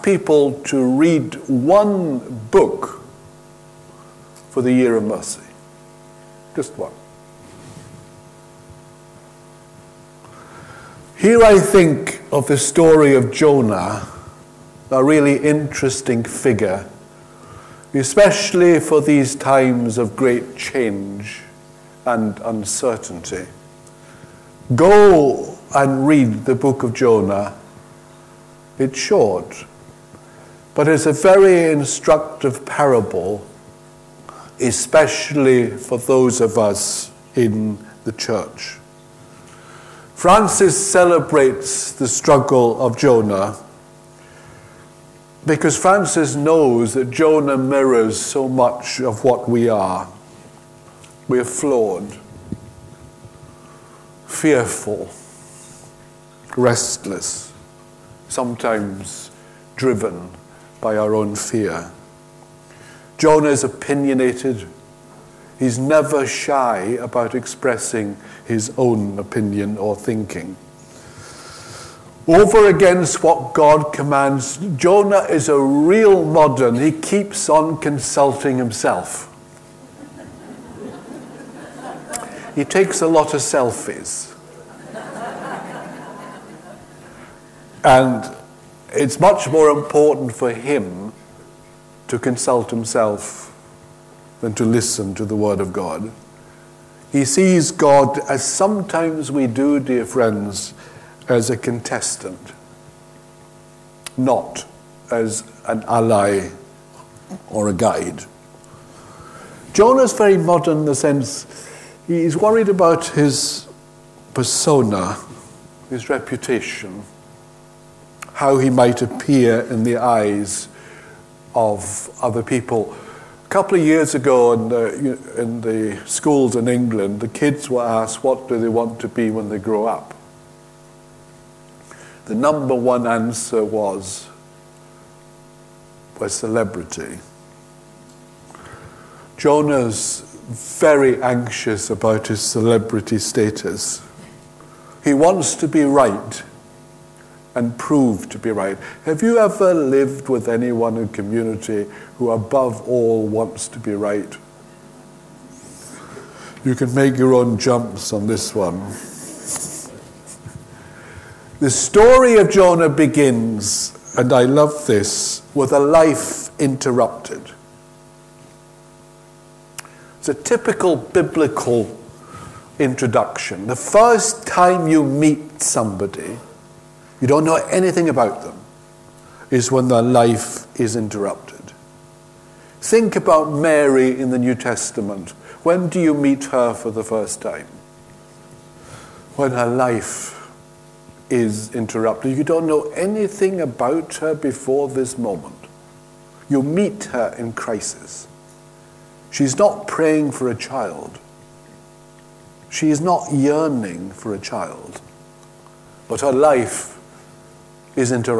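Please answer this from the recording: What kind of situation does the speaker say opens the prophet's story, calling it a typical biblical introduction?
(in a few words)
A life interrupted.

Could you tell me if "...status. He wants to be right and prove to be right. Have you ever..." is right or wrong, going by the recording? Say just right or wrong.
right.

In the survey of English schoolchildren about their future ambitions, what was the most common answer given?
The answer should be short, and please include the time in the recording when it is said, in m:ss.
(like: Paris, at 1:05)
A celebrity, at 2:16.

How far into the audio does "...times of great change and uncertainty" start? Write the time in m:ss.
0:19.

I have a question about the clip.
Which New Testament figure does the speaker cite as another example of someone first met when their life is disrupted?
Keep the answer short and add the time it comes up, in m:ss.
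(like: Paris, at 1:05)
Mary, at 3:03.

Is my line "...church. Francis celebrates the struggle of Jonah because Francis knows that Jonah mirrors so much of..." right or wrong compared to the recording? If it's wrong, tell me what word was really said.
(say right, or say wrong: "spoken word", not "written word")
right.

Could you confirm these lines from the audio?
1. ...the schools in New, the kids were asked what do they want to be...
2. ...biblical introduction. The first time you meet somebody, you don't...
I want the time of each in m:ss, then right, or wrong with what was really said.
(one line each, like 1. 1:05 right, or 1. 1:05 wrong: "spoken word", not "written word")
1. 2:05 wrong: "England", not "New"
2. 2:50 right.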